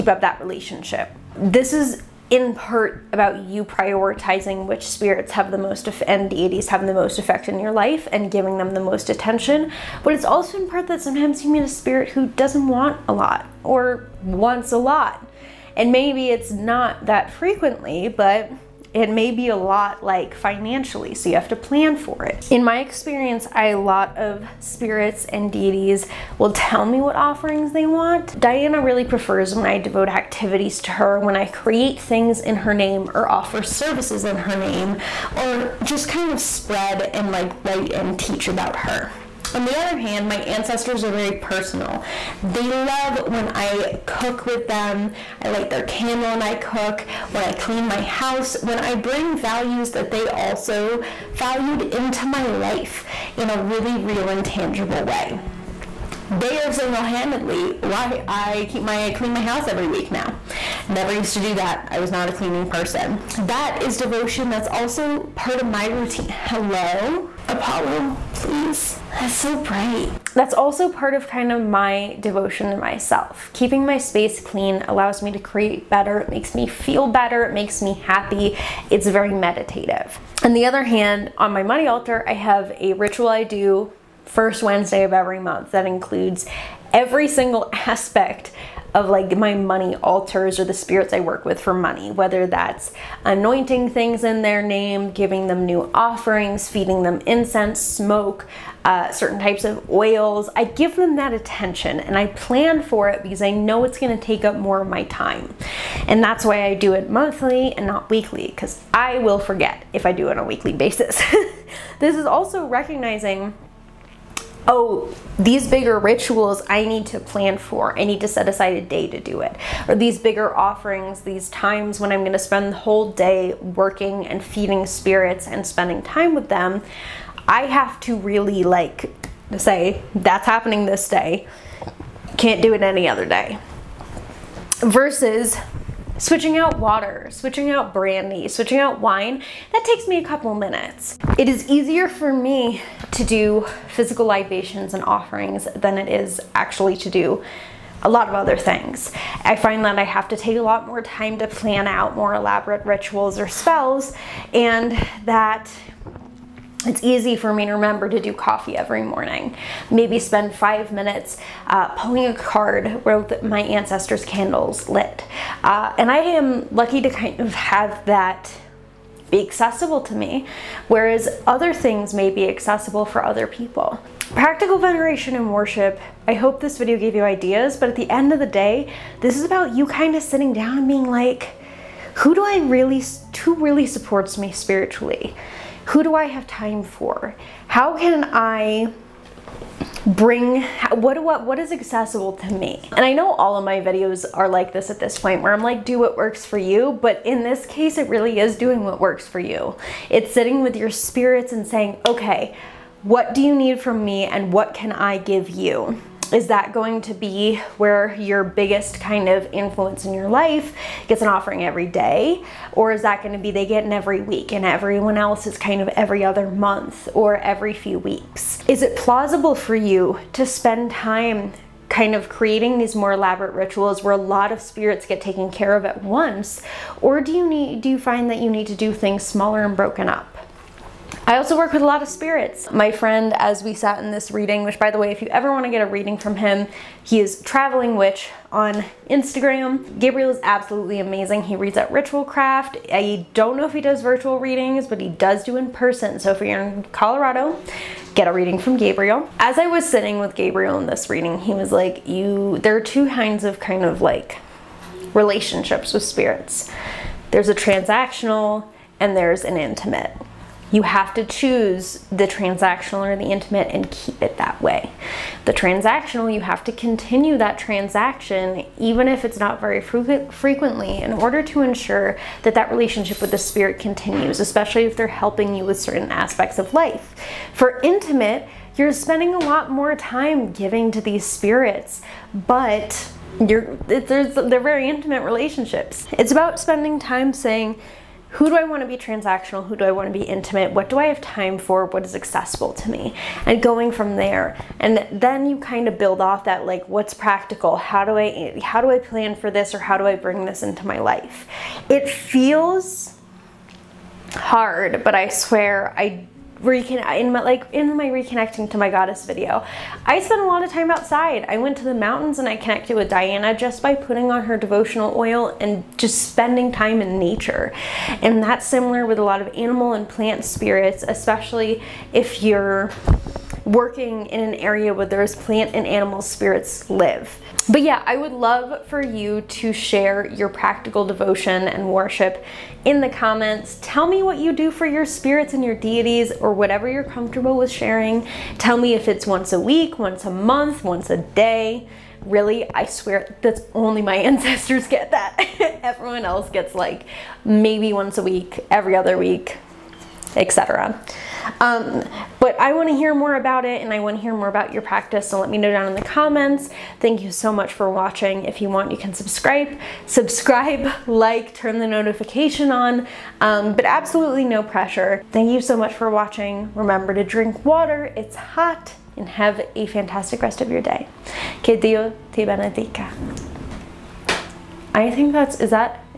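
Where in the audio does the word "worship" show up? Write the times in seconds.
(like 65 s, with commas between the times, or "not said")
175 s, 331 s.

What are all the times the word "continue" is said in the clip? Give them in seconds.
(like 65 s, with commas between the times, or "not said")
266 s, 273 s.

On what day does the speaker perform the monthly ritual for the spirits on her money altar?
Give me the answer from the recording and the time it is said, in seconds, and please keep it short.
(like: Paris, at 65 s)
First Wednesday of every month, at 84 s.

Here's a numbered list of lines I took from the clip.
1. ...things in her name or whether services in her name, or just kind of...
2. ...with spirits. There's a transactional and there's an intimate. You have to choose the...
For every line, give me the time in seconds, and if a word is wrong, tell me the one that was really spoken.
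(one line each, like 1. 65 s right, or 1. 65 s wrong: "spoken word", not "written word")
1. 31 s wrong: "offer", not "whether"
2. 255 s right.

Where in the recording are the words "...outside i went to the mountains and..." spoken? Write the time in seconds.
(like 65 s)
310 s.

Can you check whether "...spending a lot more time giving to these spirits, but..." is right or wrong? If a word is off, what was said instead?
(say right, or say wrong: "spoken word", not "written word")
right.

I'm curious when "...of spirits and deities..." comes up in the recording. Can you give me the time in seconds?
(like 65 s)
24 s.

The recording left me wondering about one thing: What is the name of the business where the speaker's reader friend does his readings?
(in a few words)
Ritual Craft.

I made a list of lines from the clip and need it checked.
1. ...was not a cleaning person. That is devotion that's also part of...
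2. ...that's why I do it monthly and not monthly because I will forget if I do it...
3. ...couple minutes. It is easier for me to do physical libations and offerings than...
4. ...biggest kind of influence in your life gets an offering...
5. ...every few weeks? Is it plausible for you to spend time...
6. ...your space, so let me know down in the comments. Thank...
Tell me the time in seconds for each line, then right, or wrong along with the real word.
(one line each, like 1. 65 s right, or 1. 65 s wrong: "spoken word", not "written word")
1. 61 s right
2. 106 s wrong: "weekly", not "monthly"
3. 140 s right
4. 208 s right
5. 217 s right
6. 354 s wrong: "practice", not "space".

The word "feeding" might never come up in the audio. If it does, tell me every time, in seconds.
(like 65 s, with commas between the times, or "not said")
96 s, 124 s.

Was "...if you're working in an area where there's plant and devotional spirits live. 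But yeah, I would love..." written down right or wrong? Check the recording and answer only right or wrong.
wrong.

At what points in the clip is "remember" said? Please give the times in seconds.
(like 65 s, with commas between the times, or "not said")
157 s, 366 s.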